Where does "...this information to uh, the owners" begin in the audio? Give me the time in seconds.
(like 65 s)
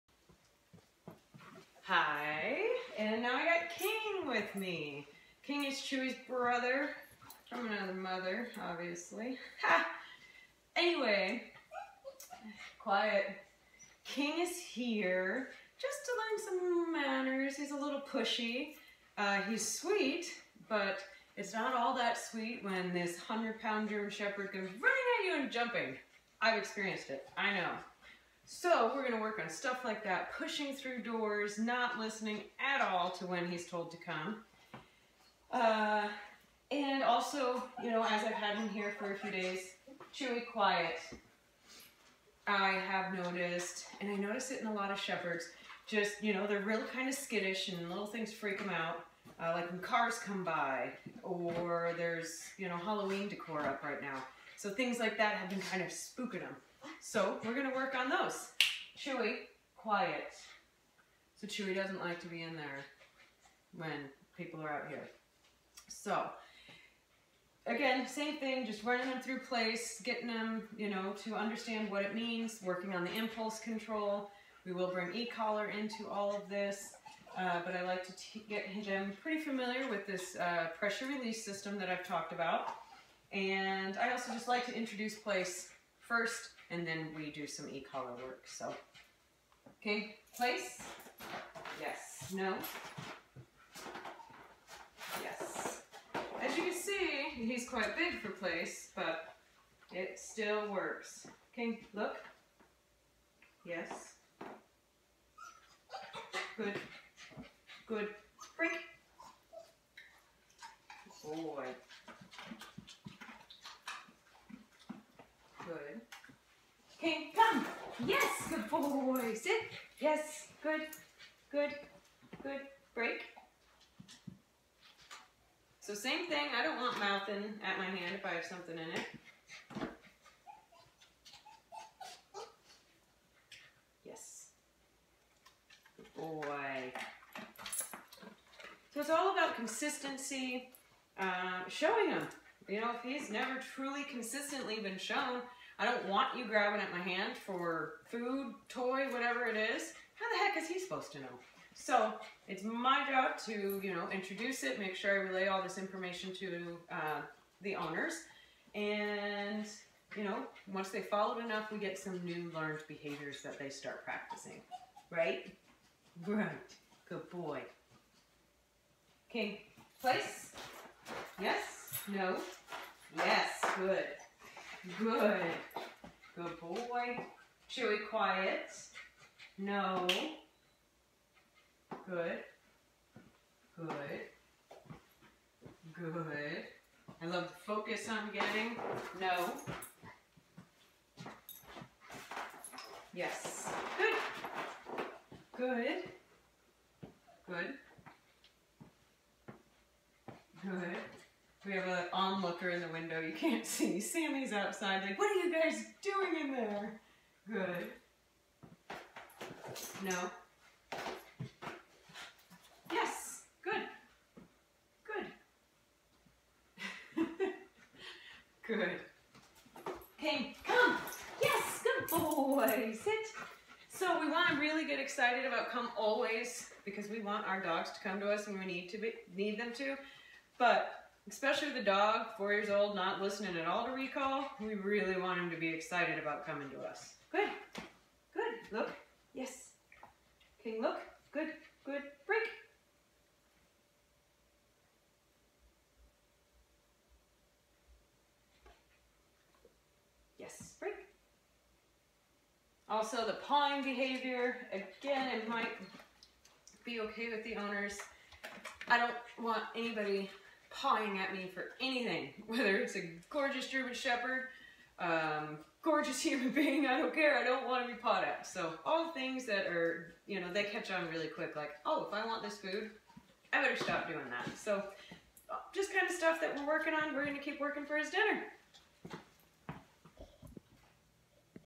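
155 s.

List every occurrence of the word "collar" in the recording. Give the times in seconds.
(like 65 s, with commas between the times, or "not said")
75 s, 87 s.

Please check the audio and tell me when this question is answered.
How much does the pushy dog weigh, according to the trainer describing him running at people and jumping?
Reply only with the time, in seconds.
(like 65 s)
23 s.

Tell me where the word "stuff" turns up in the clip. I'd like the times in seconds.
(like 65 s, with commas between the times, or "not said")
29 s, 276 s.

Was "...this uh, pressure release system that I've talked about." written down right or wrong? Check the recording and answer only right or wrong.
right.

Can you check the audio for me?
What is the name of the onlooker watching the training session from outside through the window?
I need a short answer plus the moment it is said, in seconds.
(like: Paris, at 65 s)
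Sammy, at 203 s.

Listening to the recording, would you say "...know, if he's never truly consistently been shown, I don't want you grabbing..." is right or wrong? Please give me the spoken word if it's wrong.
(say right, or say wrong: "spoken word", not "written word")
right.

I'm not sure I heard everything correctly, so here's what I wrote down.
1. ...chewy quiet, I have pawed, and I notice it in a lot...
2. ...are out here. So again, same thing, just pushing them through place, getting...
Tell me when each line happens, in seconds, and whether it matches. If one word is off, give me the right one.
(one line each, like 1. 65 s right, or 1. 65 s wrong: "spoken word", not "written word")
1. 40 s wrong: "noticed", not "pawed"
2. 64 s wrong: "running", not "pushing".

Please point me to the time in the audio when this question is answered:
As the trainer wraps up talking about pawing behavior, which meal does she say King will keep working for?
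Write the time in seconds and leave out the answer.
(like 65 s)
278 s.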